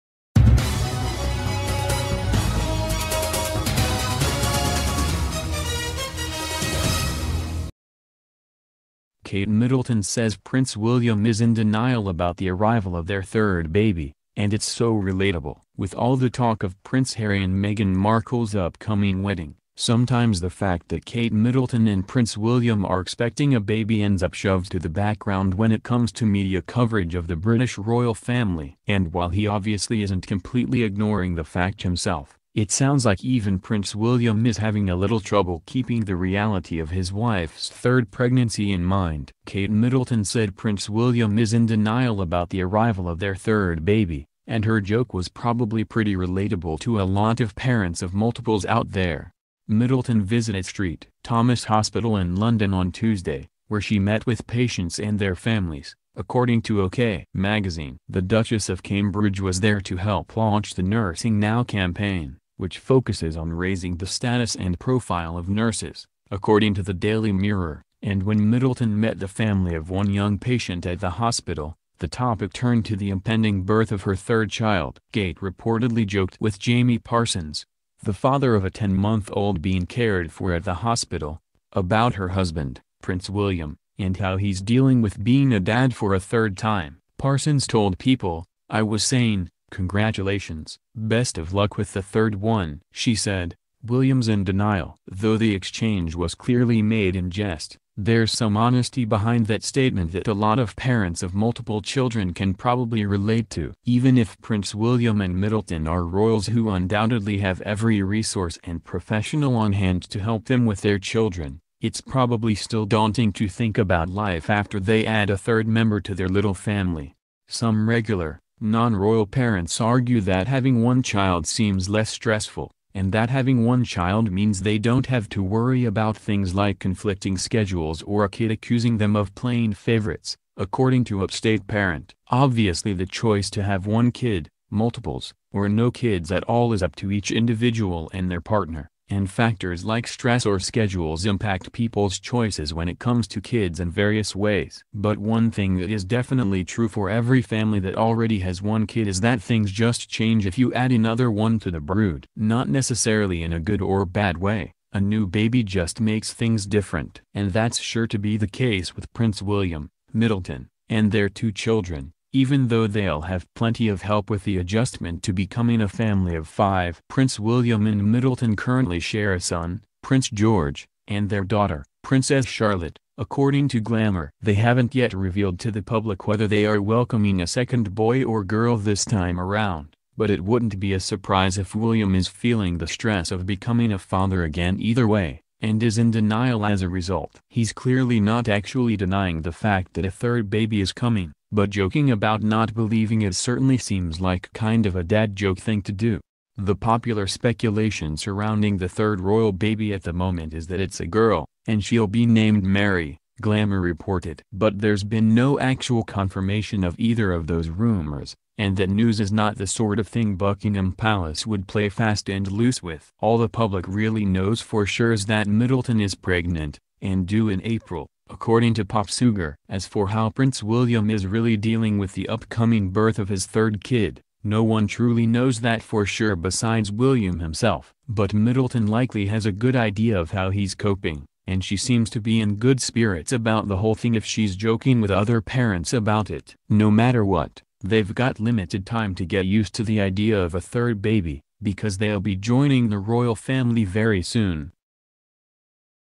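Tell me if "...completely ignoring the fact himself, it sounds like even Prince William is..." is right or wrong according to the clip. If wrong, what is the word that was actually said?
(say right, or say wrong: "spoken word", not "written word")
right.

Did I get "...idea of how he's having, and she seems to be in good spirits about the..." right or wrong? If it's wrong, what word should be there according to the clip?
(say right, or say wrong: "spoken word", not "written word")
wrong: "coping", not "having".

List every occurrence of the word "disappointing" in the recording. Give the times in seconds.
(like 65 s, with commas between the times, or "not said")
not said.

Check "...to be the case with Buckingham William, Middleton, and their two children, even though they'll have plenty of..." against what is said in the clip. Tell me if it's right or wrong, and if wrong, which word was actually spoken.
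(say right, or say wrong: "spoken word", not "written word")
wrong: "Prince", not "Buckingham".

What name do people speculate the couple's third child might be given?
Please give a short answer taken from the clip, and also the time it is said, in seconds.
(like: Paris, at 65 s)
Mary, at 202 s.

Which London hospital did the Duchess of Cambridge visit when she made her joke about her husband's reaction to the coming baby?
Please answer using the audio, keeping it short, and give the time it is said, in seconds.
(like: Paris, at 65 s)
St. Thomas Hospital, at 50 s.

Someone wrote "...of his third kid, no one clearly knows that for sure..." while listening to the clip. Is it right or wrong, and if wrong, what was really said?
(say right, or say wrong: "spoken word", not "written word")
wrong: "truly", not "clearly".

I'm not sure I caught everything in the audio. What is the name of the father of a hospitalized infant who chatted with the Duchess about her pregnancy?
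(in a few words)
Jamie Parsons.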